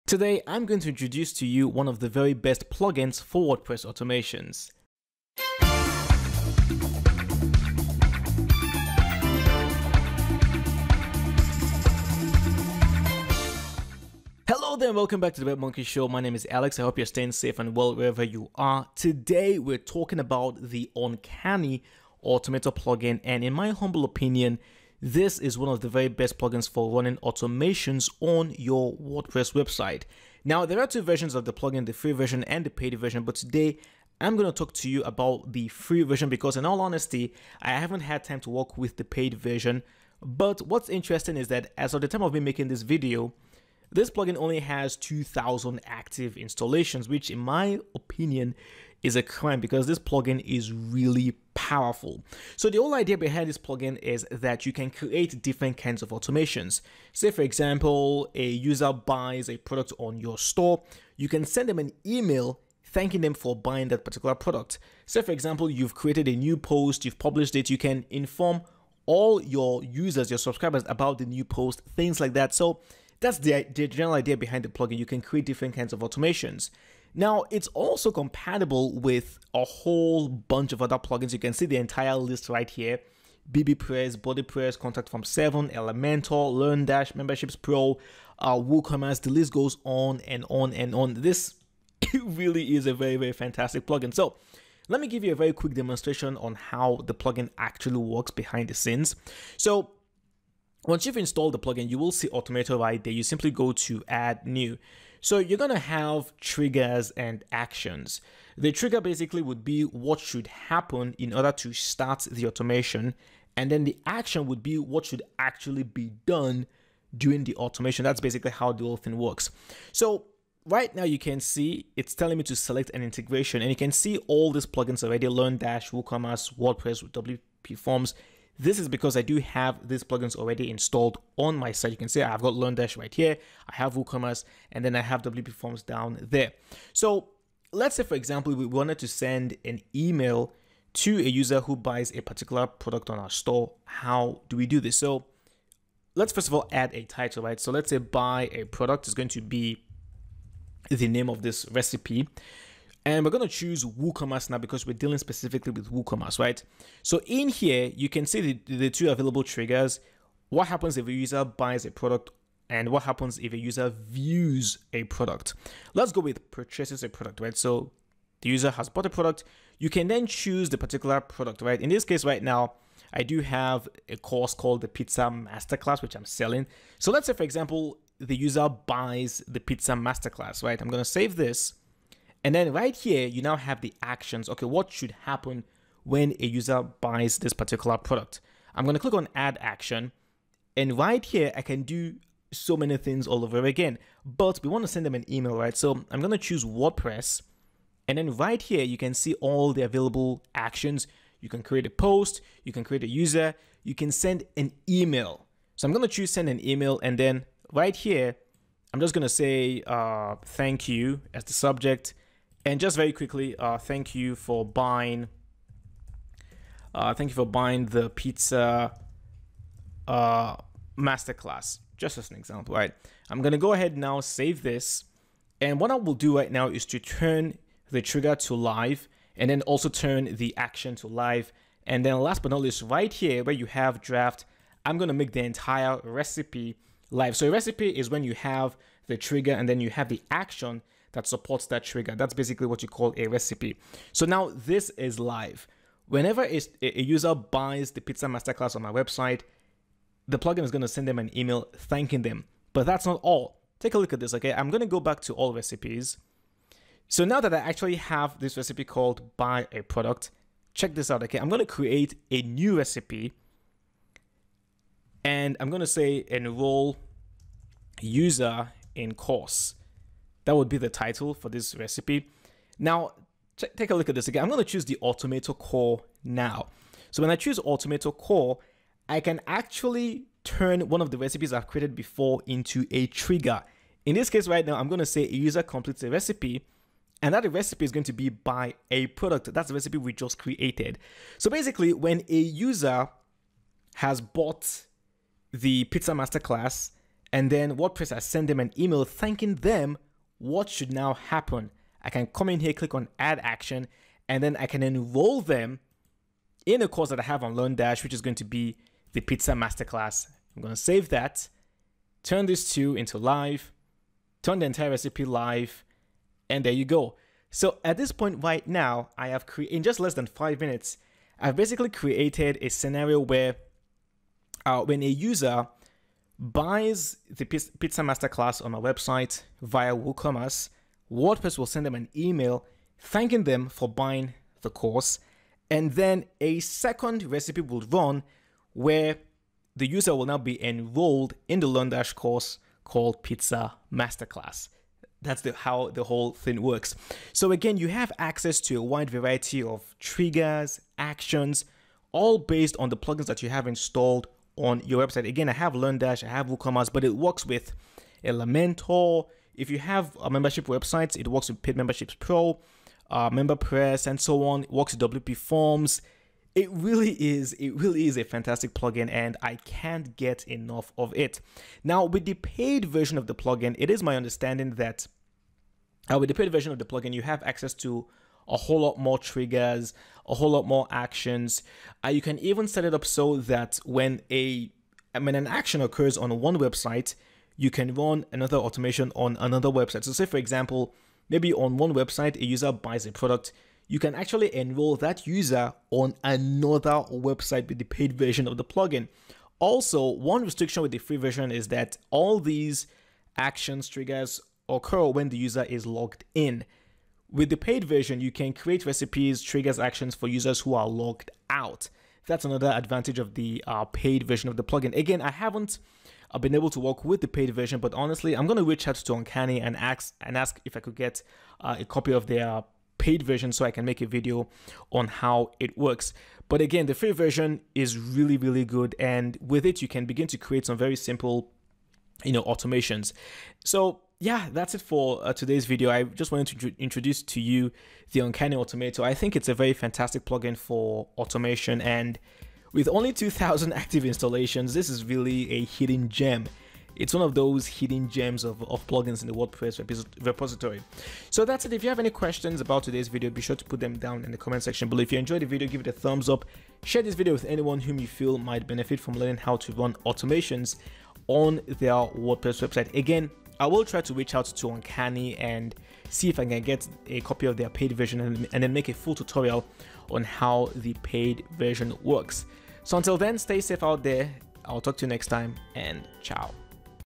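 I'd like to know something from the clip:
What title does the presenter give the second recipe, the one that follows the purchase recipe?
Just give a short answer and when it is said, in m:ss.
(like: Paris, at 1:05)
enroll user in course, at 4:26.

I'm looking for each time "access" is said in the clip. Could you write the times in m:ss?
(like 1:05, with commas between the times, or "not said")
5:48, 6:17.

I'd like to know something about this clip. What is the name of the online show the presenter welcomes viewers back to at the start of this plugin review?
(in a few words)
Web Monkey Show.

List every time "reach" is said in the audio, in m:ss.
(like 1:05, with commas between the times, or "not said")
6:58, 7:44.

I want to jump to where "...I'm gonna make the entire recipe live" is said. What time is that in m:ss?
3:54.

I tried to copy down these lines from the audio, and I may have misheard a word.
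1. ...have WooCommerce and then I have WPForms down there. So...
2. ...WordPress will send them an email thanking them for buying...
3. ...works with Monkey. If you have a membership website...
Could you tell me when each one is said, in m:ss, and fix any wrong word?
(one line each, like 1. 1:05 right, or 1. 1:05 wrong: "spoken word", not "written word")
1. 2:13 right
2. 5:31 right
3. 5:57 wrong: "Elementor", not "Monkey".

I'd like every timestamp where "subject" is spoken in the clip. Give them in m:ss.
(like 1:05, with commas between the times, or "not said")
3:31.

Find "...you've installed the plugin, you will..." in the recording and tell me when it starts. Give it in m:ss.
1:41.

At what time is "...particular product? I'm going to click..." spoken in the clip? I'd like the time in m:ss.
3:07.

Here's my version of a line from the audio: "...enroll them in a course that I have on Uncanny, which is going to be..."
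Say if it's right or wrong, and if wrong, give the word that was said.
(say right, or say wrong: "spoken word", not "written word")
wrong: "LearnDash", not "Uncanny".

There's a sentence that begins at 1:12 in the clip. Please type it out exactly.
So that's the, the general idea behind the plugin.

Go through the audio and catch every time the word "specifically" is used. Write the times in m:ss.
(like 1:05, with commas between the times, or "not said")
2:35.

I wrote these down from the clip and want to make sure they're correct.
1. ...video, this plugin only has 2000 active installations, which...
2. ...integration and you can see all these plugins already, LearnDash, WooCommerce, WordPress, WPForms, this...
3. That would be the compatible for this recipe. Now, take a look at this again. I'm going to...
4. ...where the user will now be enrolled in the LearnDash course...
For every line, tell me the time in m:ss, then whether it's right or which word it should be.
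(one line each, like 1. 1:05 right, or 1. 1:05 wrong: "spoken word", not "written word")
1. 0:42 right
2. 2:03 right
3. 4:30 wrong: "title", not "compatible"
4. 5:38 right.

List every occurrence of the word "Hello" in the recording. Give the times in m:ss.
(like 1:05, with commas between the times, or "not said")
0:14.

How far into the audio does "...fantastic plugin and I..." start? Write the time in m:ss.
6:08.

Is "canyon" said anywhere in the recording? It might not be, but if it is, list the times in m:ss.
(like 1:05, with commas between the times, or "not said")
not said.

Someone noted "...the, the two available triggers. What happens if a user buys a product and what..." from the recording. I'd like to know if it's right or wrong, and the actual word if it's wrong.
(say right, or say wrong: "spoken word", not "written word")
right.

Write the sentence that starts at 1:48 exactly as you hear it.
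The trigger basically would be what should happen in order to start the automation.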